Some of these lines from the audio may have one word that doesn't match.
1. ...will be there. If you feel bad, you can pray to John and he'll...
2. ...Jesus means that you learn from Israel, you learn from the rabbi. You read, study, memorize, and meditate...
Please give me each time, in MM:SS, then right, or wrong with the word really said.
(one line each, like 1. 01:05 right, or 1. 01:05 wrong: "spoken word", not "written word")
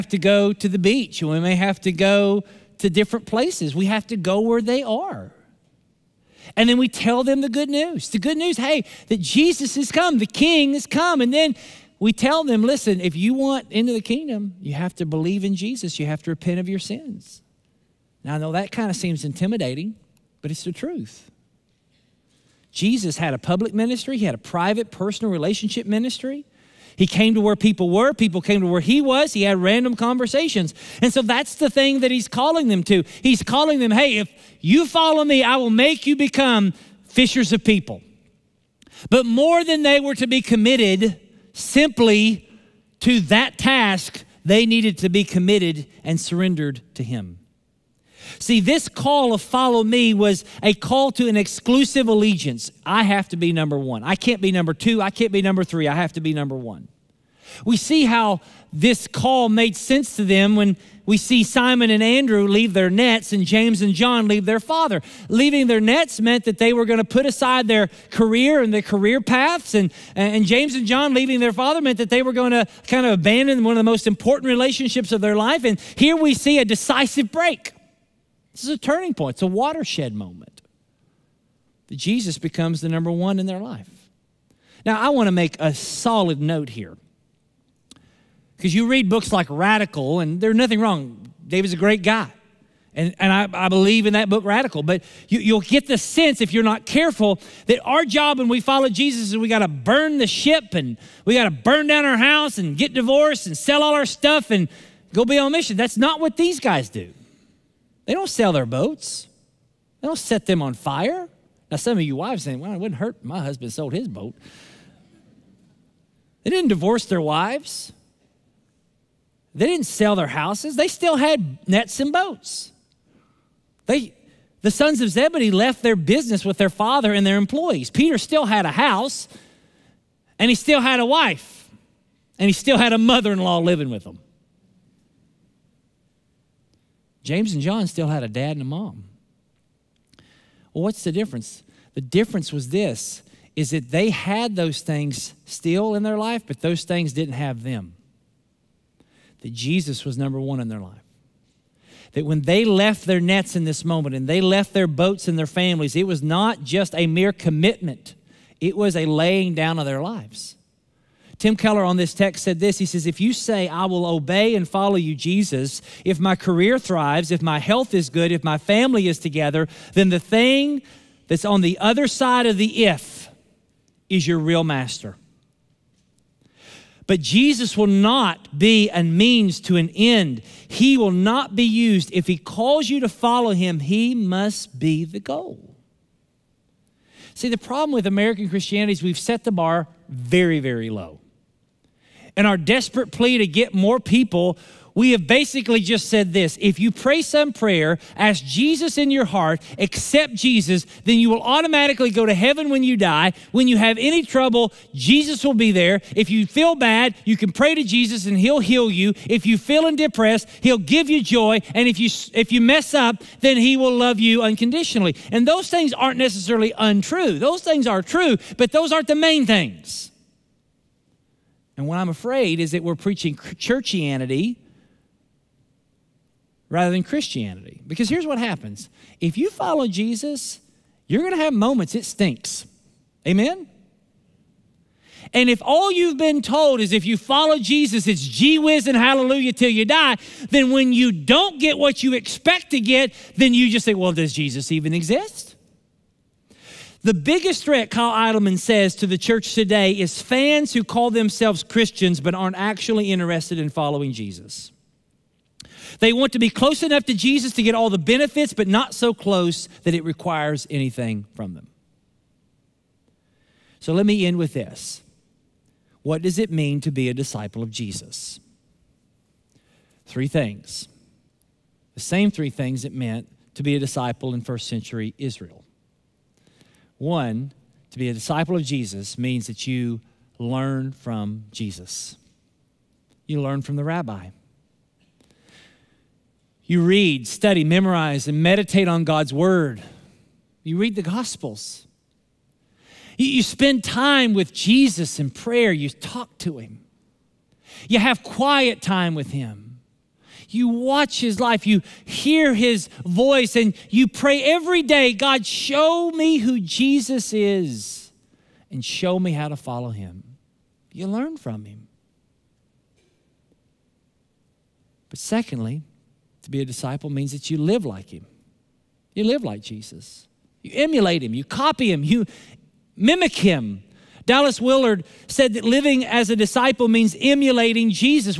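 1. 03:25 wrong: "Jesus", not "John"
2. 04:38 wrong: "Jesus", not "Israel".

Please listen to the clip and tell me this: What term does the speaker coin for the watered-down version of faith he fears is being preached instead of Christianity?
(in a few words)
churchianity.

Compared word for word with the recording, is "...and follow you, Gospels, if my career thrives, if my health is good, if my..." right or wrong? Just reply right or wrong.
wrong.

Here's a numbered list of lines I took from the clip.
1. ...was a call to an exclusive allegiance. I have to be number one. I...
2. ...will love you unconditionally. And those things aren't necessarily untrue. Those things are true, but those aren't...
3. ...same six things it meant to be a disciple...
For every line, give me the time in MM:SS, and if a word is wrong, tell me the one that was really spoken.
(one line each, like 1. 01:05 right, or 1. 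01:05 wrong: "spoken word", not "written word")
1. 00:50 right
2. 03:33 right
3. 04:31 wrong: "three", not "six".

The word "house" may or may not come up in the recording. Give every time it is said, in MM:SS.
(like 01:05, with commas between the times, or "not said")
01:42, 02:00, 02:08.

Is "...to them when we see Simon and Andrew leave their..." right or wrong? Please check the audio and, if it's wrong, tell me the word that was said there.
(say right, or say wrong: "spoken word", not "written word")
right.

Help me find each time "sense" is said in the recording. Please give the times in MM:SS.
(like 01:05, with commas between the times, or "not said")
00:59, 01:35.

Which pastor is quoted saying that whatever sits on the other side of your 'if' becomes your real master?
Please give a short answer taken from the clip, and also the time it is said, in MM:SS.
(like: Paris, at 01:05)
Tim Keller, at 02:41.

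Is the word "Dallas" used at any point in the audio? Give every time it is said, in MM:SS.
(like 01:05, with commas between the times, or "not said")
05:24.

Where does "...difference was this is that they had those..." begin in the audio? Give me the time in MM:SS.
02:21.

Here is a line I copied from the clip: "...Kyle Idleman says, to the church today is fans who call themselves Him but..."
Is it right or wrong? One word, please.
wrong.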